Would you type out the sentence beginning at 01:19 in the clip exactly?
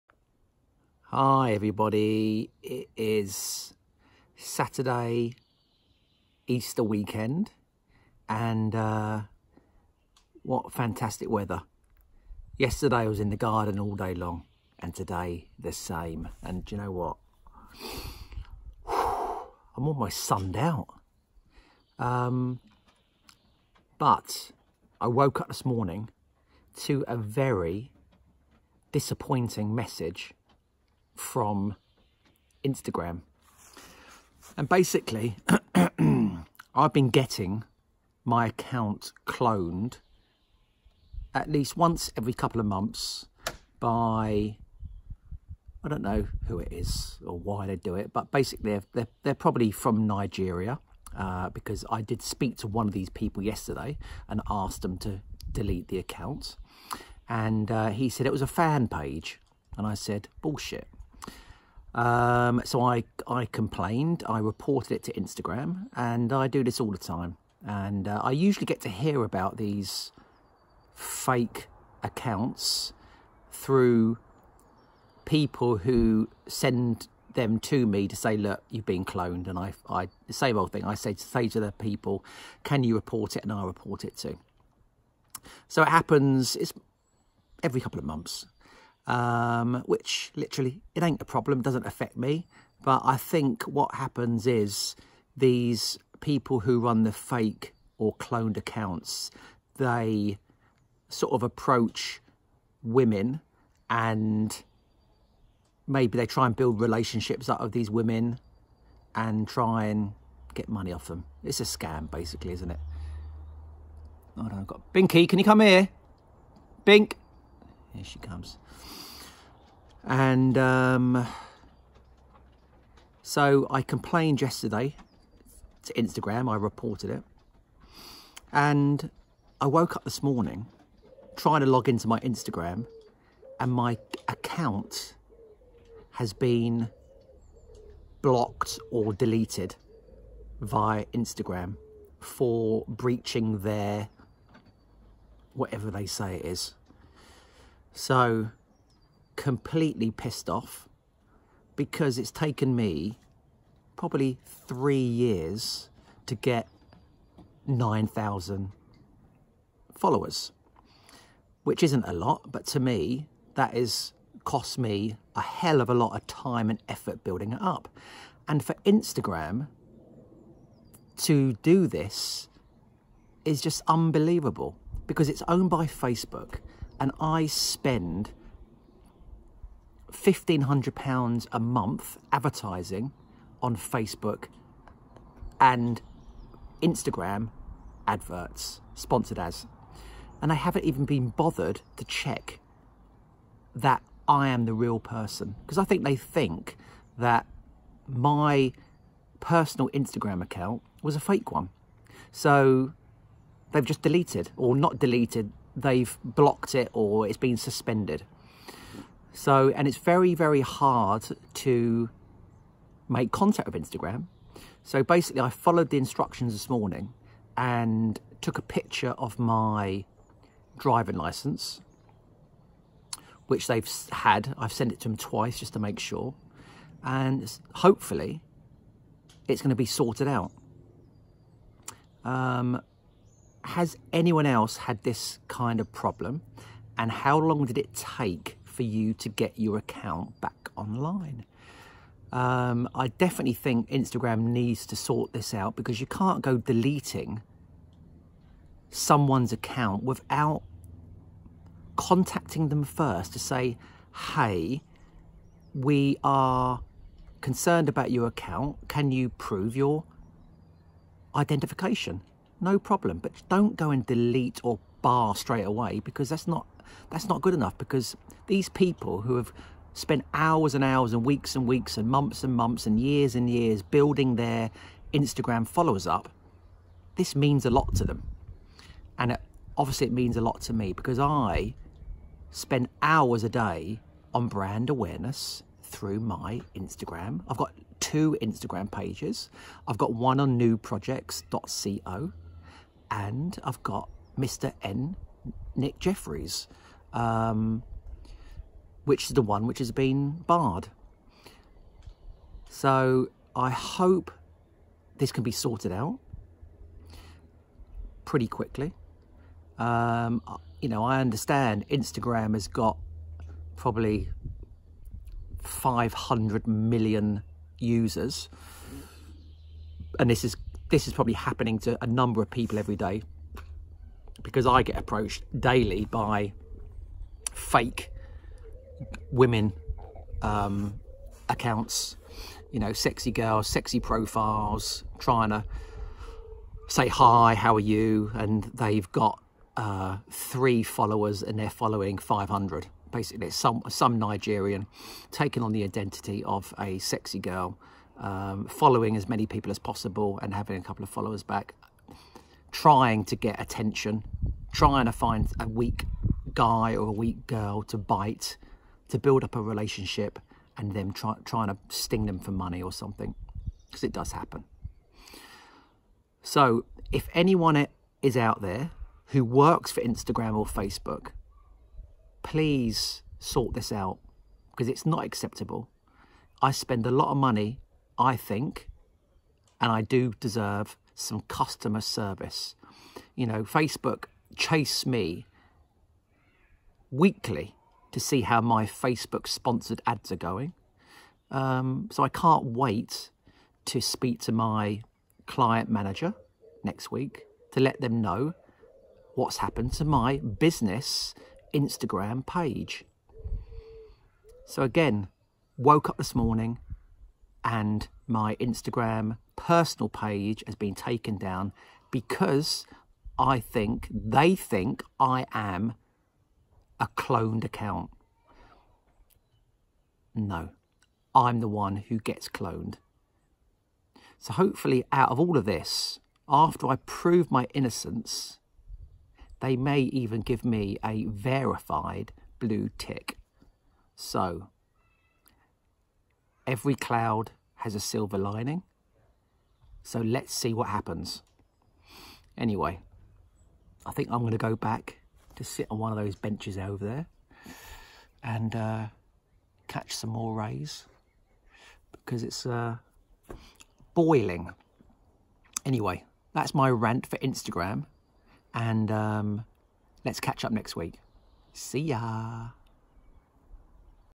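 And I, I the same old thing, I say, say to the people, can you report it?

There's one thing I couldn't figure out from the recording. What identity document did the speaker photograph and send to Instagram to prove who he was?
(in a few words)
Driving license.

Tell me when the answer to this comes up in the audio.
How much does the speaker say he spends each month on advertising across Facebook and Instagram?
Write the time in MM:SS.
03:00.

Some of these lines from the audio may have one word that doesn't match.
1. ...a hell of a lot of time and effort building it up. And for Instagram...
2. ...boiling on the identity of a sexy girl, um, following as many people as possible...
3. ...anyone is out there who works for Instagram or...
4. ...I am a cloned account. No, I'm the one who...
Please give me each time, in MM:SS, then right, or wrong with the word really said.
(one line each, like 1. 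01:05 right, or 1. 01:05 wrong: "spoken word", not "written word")
1. 02:45 right
2. 05:45 wrong: "taking", not "boiling"
3. 06:07 right
4. 06:55 right.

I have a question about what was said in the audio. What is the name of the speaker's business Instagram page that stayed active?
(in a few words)
nuprojects.co.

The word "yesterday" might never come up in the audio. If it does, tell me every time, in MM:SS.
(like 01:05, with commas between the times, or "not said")
00:12, 00:53, 02:04.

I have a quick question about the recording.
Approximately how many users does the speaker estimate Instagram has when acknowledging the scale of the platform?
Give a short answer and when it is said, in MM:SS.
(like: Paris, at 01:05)
500 million, at 05:15.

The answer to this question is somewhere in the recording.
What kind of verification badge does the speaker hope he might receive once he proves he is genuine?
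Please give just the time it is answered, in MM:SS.
07:12.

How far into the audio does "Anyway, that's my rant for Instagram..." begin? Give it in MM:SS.
07:35.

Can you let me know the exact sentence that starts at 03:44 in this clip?
I've sent it to them twice just to make sure.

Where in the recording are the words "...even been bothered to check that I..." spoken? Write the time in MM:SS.
03:10.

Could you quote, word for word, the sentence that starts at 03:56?
And how long did it take for you to get your account back online.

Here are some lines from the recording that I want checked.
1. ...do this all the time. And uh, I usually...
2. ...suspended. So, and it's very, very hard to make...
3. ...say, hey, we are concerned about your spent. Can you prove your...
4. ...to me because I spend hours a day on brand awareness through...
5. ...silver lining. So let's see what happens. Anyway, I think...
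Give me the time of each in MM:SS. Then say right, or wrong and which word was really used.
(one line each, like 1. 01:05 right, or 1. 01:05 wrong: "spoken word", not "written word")
1. 01:06 right
2. 03:27 right
3. 04:13 wrong: "account", not "spent"
4. 04:40 right
5. 07:17 right.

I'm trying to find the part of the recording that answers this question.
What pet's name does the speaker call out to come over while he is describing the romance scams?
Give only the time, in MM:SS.
01:54.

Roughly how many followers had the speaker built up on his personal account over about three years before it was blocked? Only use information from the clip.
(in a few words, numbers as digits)
9,000.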